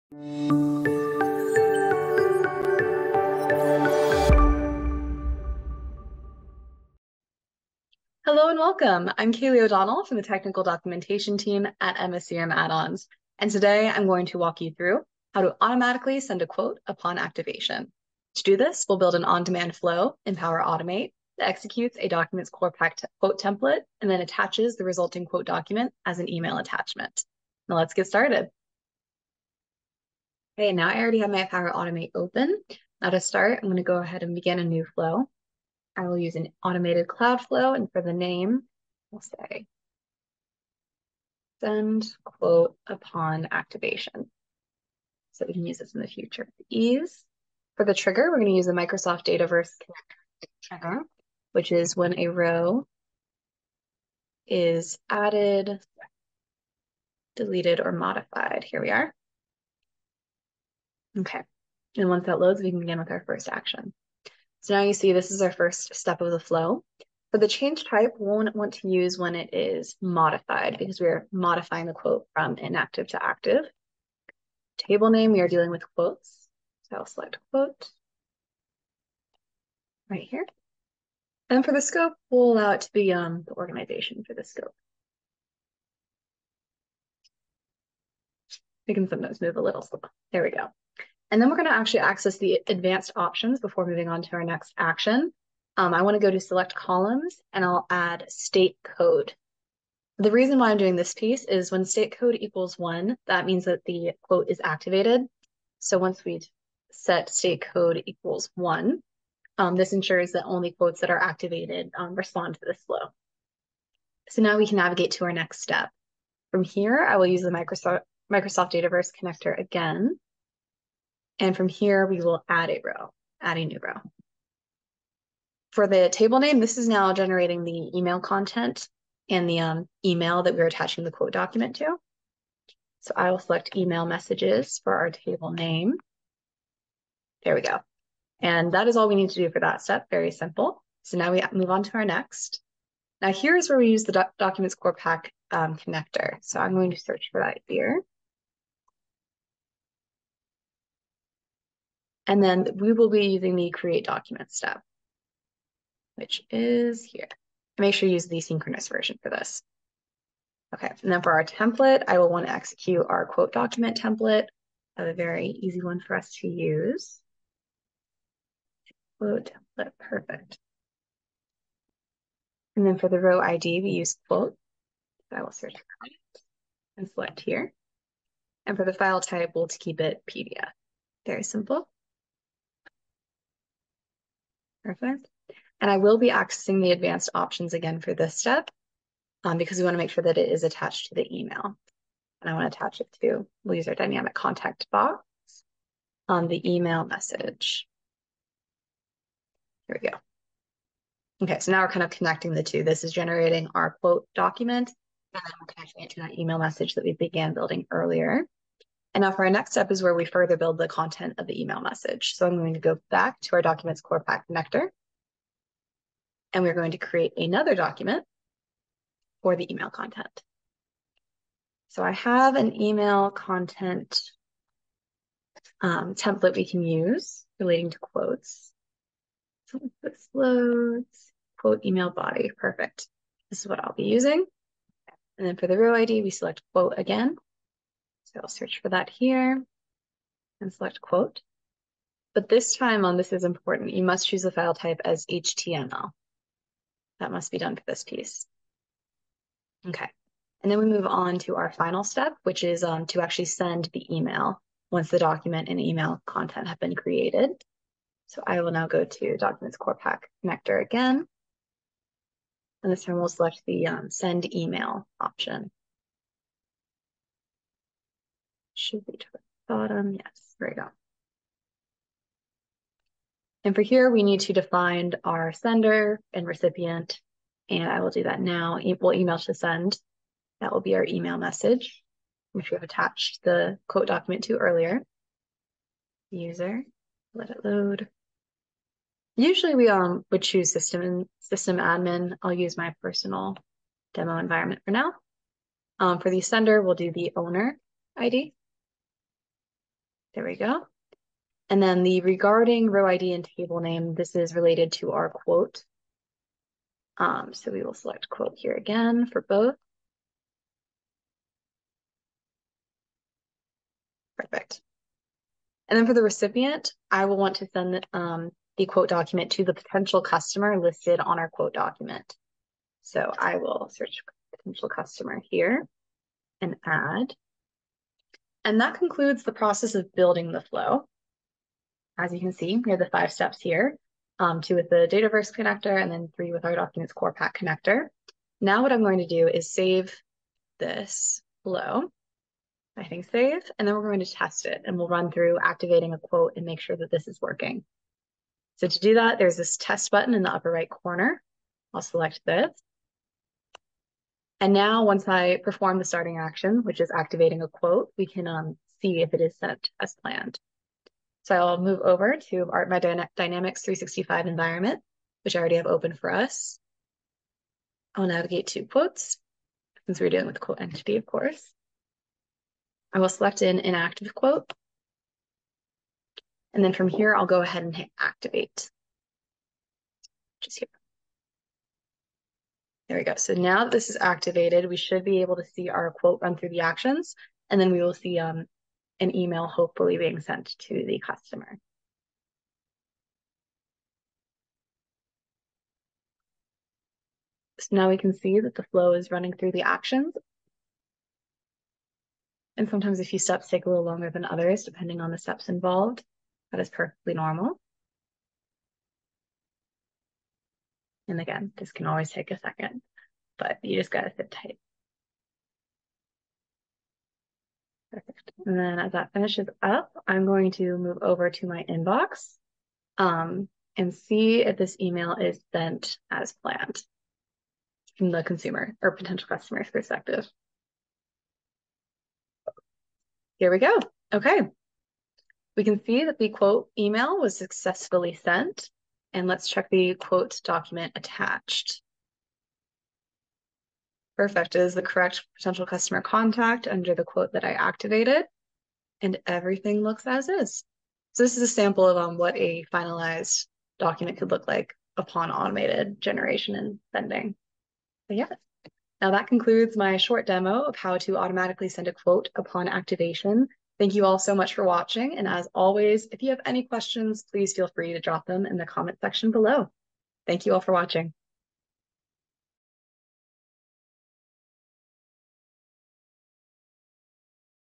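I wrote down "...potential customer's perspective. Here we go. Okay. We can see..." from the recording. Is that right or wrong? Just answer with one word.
right.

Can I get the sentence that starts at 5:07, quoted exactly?
Um, so we will select quote here again for both.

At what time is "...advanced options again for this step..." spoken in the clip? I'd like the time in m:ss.
3:06.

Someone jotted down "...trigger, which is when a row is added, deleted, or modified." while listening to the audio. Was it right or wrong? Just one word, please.
right.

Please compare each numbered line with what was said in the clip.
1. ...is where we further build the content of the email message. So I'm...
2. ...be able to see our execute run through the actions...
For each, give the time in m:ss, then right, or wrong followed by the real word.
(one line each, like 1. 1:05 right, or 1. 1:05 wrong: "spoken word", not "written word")
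1. 3:29 right
2. 6:25 wrong: "quote", not "execute".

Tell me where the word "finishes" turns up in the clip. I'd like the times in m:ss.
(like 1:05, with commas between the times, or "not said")
6:59.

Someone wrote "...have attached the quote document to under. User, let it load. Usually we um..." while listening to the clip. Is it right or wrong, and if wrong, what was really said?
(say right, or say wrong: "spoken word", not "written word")
wrong: "earlier", not "under".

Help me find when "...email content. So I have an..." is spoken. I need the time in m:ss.
3:39.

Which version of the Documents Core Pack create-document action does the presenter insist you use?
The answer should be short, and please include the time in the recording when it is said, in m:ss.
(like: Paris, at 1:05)
Synchronous, at 2:38.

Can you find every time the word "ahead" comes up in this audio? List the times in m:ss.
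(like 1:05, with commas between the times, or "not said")
0:33, 6:17.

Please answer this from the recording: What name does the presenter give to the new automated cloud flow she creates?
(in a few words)
Send quote upon activation.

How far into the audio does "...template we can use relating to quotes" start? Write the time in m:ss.
3:46.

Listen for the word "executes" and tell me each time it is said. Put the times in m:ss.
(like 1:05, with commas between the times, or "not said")
0:21, 2:42.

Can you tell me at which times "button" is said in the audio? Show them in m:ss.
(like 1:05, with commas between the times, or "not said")
5:50.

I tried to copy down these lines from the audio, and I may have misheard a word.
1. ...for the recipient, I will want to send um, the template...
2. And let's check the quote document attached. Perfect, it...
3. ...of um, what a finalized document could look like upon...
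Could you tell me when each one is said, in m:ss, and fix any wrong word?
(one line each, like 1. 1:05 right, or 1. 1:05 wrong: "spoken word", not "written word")
1. 5:16 wrong: "quote", not "template"
2. 7:19 right
3. 7:32 right.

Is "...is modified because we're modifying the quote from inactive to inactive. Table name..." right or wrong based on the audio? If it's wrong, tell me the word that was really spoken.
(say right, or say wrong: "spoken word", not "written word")
wrong: "active", not "inactive".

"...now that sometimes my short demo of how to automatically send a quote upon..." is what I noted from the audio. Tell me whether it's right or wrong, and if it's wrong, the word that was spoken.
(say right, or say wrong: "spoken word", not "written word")
wrong: "concludes", not "sometimes".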